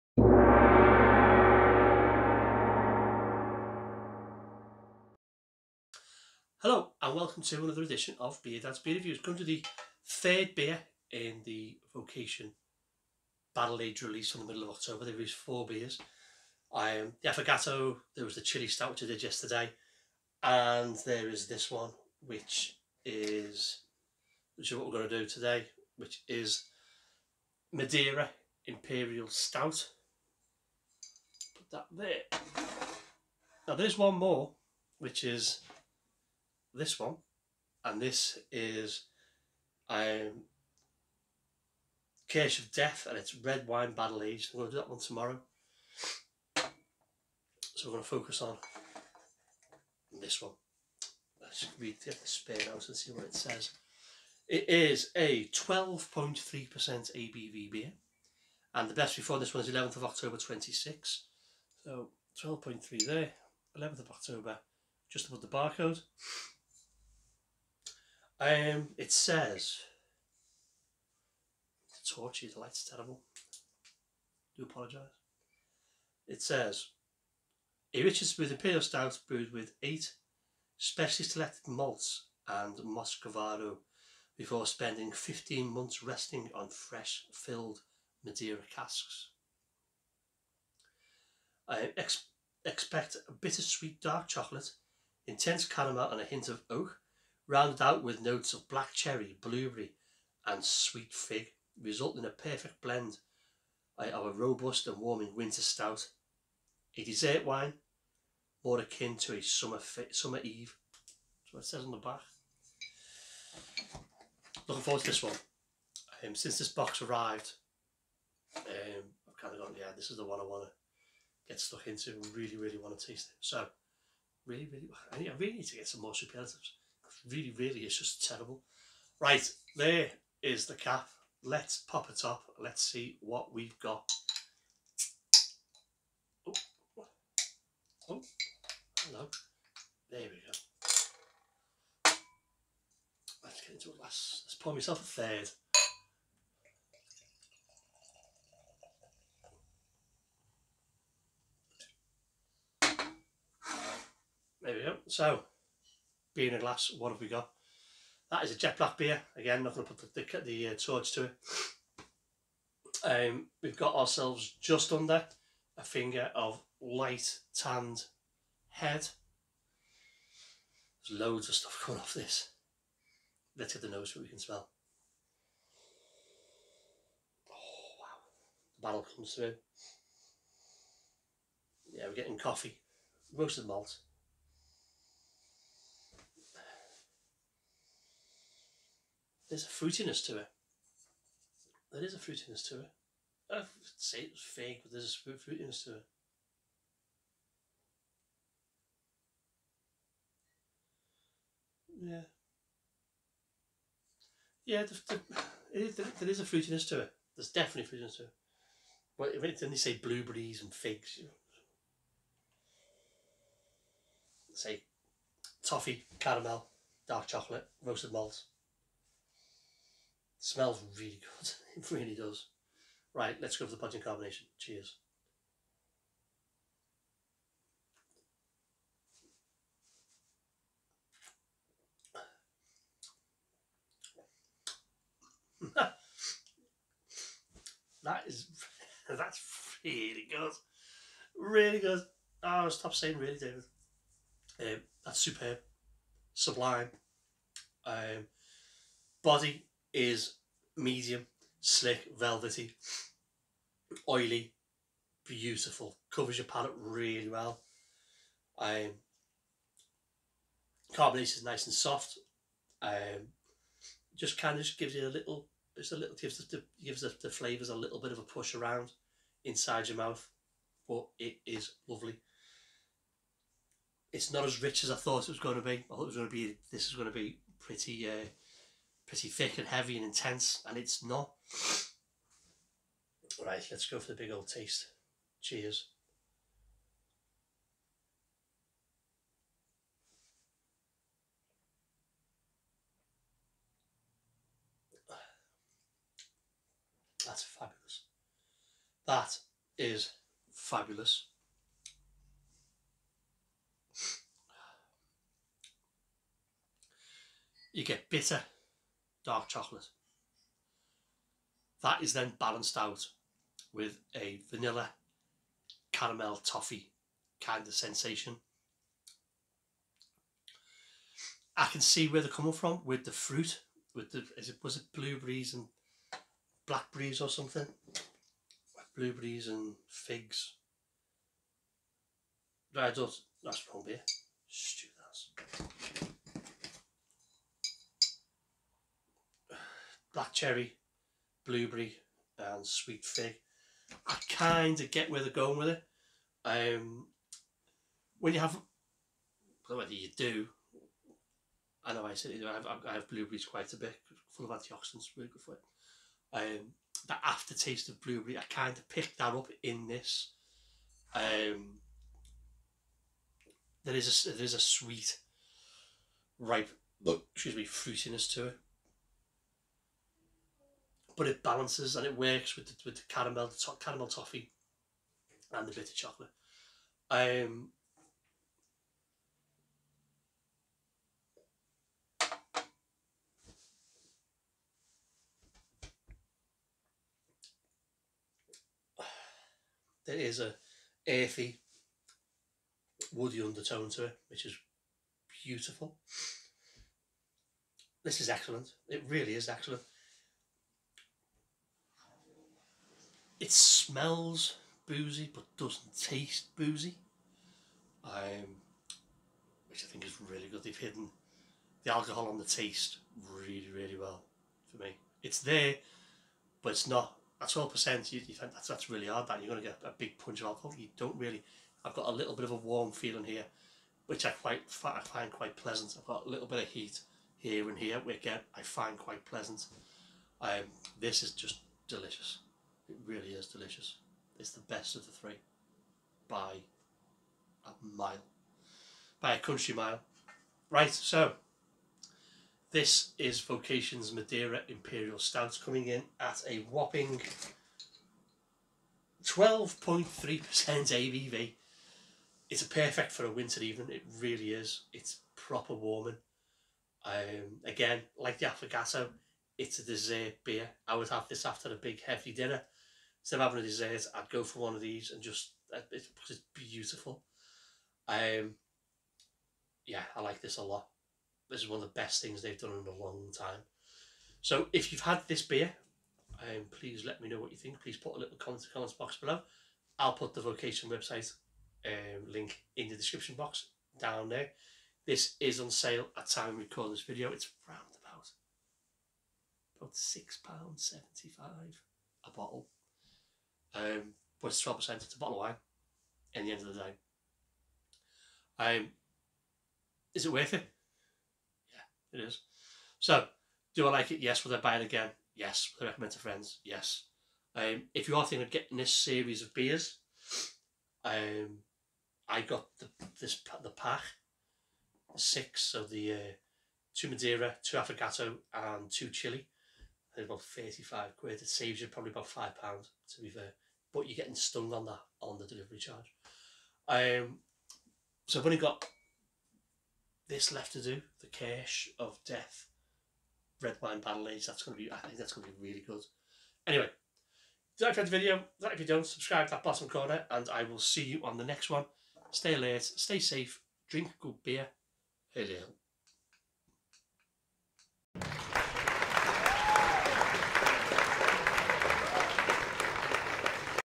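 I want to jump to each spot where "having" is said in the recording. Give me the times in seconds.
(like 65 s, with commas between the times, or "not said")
463 s.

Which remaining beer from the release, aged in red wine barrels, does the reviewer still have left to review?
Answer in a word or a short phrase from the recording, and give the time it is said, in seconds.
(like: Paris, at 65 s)
Case of Death, at 42 s.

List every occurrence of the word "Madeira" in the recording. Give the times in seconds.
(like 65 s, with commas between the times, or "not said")
27 s, 88 s, 444 s, 517 s.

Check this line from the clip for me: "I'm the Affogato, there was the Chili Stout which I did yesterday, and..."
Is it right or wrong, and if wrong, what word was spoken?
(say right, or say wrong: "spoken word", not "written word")
right.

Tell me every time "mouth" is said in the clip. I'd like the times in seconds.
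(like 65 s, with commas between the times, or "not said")
269 s.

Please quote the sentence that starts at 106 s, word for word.
A dessert wine, more akin to a summer, summer eve.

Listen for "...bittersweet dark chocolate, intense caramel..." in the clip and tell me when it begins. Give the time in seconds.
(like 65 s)
93 s.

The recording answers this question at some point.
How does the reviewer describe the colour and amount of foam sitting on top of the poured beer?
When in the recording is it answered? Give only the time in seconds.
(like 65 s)
166 s.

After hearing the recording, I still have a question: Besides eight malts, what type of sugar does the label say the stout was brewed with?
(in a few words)
Muscovado.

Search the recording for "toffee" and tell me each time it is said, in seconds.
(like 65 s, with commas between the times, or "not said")
215 s, 316 s, 374 s.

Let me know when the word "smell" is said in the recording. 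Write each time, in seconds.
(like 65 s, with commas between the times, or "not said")
174 s, 220 s, 403 s.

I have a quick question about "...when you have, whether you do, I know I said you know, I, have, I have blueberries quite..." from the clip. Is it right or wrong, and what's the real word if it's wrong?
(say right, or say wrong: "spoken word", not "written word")
right.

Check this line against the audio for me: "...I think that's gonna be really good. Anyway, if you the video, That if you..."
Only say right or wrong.
right.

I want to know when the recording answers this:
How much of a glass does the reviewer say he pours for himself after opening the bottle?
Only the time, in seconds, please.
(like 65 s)
145 s.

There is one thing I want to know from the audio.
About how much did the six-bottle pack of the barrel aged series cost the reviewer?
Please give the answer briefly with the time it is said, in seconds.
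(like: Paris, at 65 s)
£35, at 520 s.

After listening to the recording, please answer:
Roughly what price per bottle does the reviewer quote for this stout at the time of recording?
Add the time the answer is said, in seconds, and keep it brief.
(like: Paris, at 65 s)
£6.75, at 489 s.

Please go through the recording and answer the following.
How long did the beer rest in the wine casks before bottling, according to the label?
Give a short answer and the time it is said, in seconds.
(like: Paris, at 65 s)
15 months, at 85 s.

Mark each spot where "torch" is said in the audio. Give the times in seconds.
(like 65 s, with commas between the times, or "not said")
72 s, 160 s.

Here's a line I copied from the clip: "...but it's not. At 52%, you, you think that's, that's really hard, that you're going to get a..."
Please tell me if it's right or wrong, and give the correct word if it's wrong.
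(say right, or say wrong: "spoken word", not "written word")
wrong: "12", not "52".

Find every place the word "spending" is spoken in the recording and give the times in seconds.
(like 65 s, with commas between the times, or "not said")
84 s.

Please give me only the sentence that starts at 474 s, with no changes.
So if you've had this beer, um, please let me know what you think.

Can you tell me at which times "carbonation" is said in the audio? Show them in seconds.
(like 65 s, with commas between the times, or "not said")
260 s.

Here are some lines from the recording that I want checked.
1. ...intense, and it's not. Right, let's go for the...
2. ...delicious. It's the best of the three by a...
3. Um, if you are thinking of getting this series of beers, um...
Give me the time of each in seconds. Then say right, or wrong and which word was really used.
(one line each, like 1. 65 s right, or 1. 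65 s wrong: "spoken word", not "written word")
1. 280 s right
2. 433 s right
3. 507 s right.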